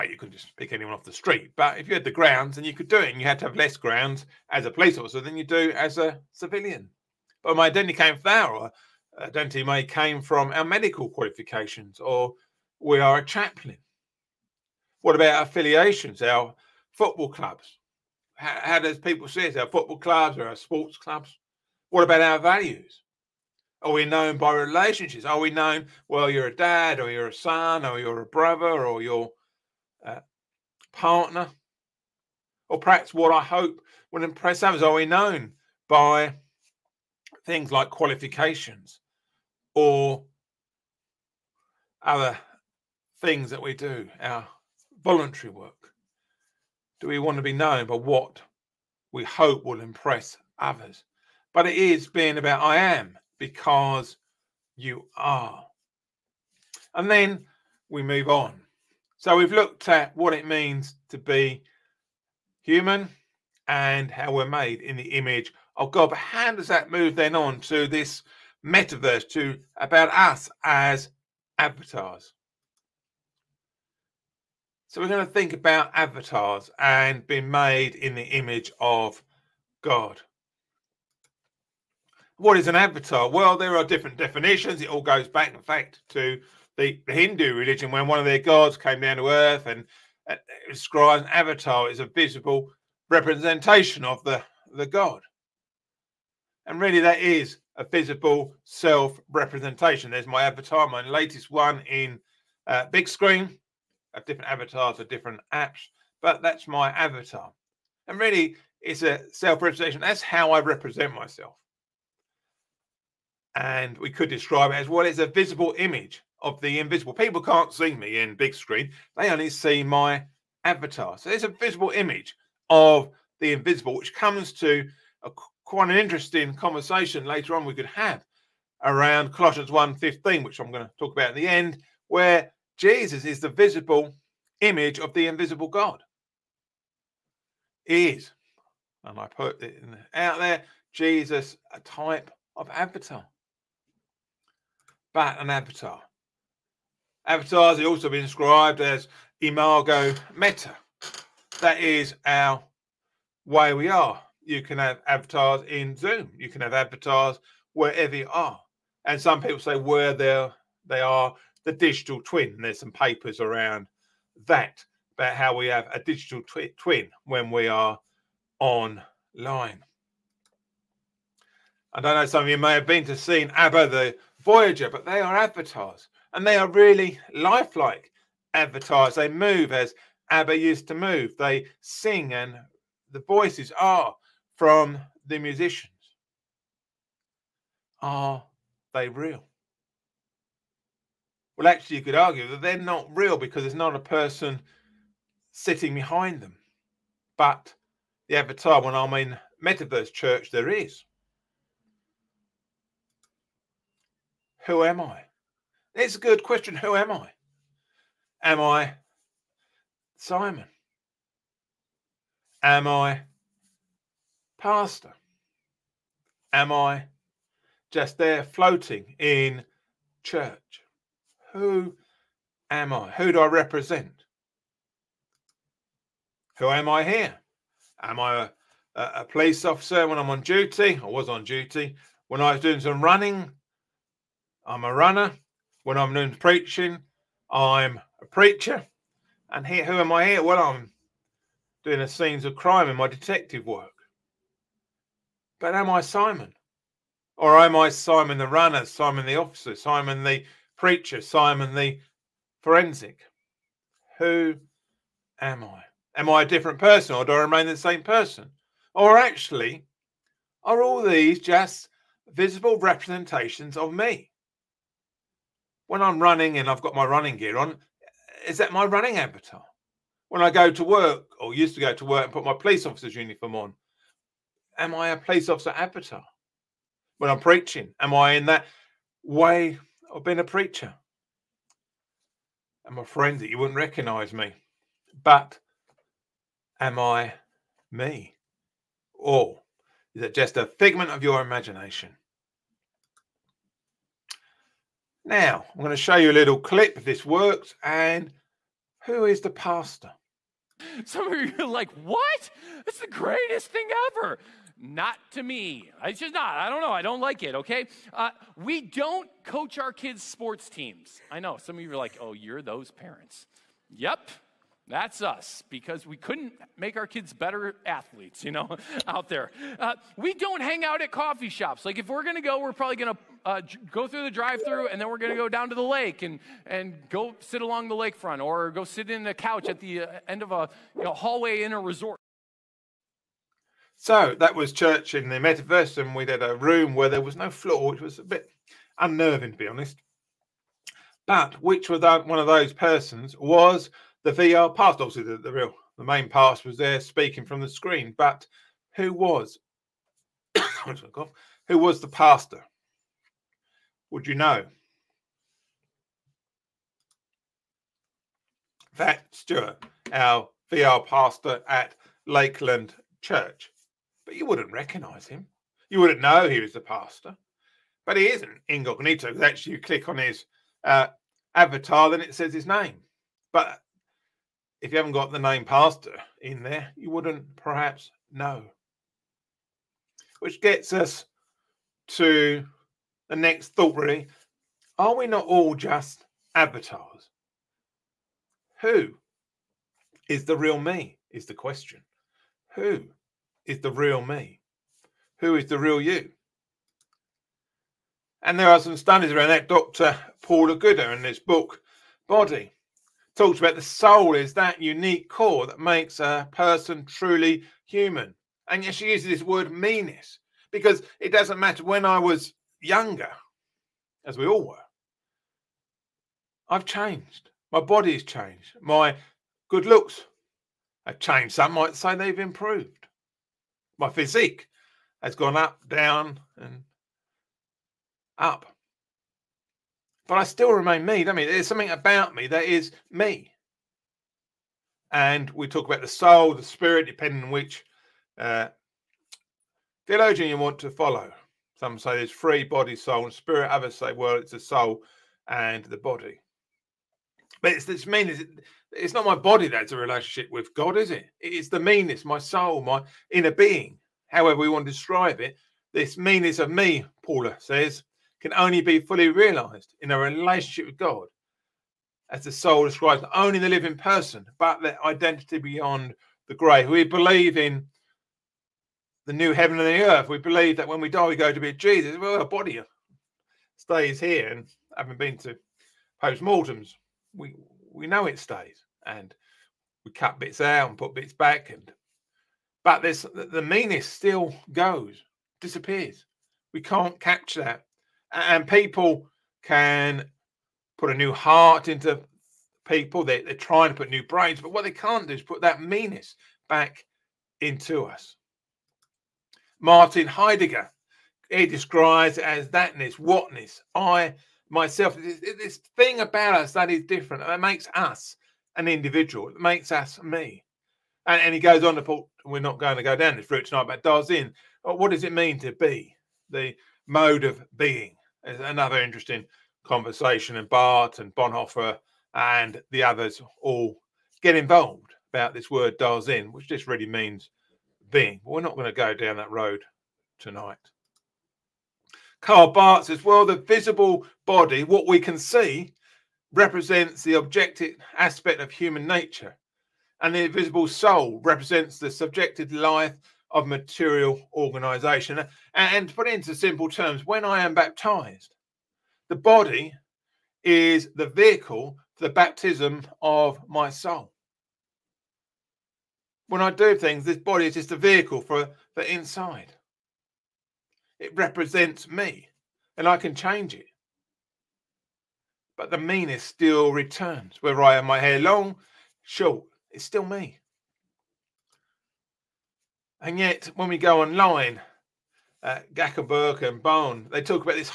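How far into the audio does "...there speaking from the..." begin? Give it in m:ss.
5:46.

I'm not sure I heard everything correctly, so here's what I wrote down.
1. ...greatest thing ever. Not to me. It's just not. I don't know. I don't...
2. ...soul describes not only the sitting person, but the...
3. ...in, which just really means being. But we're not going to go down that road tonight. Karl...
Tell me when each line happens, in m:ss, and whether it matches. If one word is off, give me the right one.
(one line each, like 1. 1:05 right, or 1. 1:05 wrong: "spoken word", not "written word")
1. 5:03 right
2. 7:42 wrong: "living", not "sitting"
3. 8:46 right.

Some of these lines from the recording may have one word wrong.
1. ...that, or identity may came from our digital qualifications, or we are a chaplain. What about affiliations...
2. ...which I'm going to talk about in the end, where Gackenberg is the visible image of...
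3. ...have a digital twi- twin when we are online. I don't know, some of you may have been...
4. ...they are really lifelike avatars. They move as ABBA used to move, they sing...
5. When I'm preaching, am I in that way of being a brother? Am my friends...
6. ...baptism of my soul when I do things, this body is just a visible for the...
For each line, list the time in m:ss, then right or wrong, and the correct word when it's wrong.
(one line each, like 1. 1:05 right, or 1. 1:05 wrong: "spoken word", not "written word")
1. 0:08 wrong: "medical", not "digital"
2. 2:10 wrong: "Jesus", not "Gackenberg"
3. 2:45 right
4. 2:56 right
5. 4:37 wrong: "preacher", not "brother"
6. 9:12 wrong: "vehicle", not "visible".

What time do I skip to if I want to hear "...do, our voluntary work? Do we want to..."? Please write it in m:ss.
0:43.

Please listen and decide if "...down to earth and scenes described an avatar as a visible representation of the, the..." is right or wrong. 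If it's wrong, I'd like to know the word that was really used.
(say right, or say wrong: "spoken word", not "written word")
wrong: "describes", not "scenes".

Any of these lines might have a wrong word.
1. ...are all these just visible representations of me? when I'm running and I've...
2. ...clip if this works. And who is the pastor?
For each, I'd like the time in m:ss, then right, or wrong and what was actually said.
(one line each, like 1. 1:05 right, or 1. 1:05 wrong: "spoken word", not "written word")
1. 4:20 right
2. 4:56 right.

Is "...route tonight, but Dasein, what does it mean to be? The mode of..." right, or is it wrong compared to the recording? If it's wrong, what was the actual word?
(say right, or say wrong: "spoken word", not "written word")
right.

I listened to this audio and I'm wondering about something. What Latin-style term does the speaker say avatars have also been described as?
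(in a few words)
imago meta.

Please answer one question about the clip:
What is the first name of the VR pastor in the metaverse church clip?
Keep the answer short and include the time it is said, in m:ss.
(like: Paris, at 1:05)
Stuart, at 5:59.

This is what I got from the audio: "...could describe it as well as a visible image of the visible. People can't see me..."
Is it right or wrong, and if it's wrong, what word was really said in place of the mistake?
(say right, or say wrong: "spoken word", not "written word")
wrong: "invisible", not "visible".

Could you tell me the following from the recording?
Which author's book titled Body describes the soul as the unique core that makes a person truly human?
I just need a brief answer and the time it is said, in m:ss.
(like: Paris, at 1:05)
Paula Gooder, at 6:40.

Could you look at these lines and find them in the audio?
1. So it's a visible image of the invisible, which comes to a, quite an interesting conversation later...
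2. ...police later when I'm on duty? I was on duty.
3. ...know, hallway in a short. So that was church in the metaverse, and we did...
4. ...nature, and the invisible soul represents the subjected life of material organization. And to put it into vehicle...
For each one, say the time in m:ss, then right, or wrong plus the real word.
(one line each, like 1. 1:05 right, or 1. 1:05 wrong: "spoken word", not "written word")
1. 2:01 right
2. 3:49 wrong: "officer", not "later"
3. 5:31 wrong: "resort", not "short"
4. 8:59 wrong: "simple", not "vehicle".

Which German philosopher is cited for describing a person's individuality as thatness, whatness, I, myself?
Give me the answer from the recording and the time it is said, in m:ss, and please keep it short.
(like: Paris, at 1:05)
Martin Heidegger, at 8:19.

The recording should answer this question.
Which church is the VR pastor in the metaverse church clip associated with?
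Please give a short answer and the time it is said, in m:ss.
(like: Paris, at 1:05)
Lakeland Church, at 6:02.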